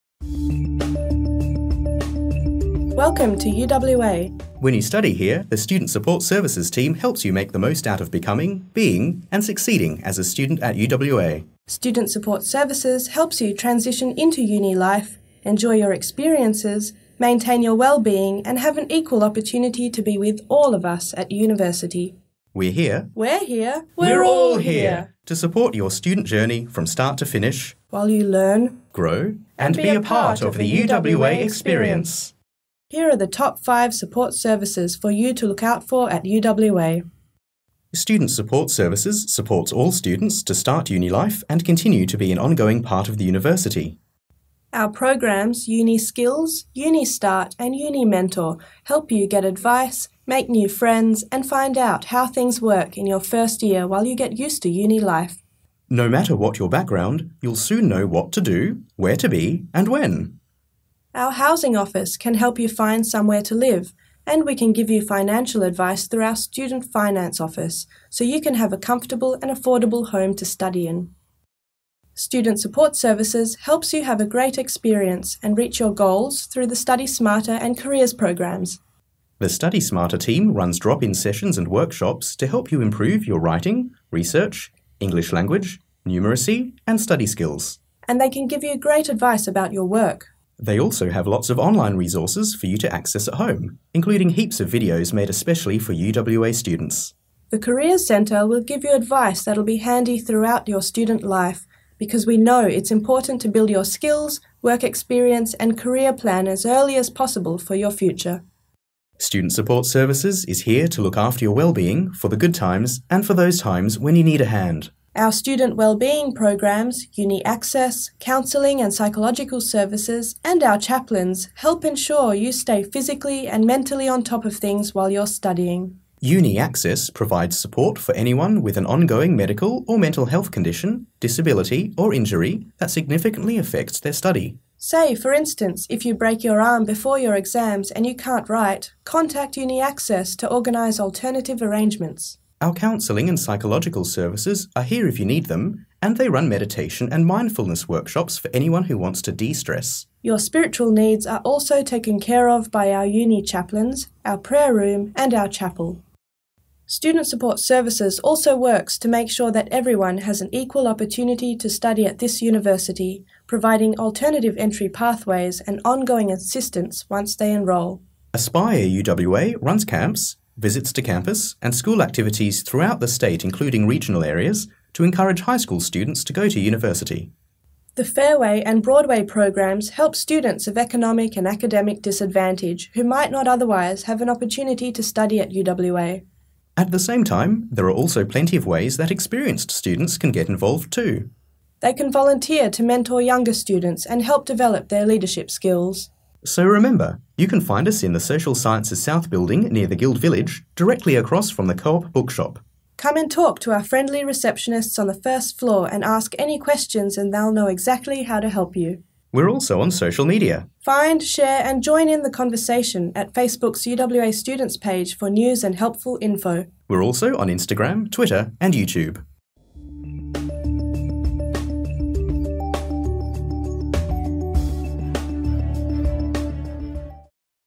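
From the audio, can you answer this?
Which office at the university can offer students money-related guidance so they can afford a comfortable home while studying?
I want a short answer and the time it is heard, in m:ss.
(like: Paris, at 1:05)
Student Finance Office, at 1:06.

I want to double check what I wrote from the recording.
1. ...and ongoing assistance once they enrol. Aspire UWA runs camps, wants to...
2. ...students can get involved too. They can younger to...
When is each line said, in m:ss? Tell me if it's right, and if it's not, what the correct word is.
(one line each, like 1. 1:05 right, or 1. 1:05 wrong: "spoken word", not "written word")
1. 2:45 wrong: "visits", not "wants"
2. 3:09 wrong: "volunteer", not "younger".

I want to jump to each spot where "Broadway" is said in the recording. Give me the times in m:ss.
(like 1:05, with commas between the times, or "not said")
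2:58.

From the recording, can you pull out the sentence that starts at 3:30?
Find, share, and join in the conversation at Facebook's UWA Students page for news and helpful info.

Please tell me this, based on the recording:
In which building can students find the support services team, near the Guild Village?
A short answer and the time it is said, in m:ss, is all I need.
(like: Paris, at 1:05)
Social Sciences South, at 3:18.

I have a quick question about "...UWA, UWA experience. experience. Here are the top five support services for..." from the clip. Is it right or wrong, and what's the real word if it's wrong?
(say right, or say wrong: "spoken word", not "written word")
right.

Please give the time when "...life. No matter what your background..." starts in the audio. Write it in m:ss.
0:54.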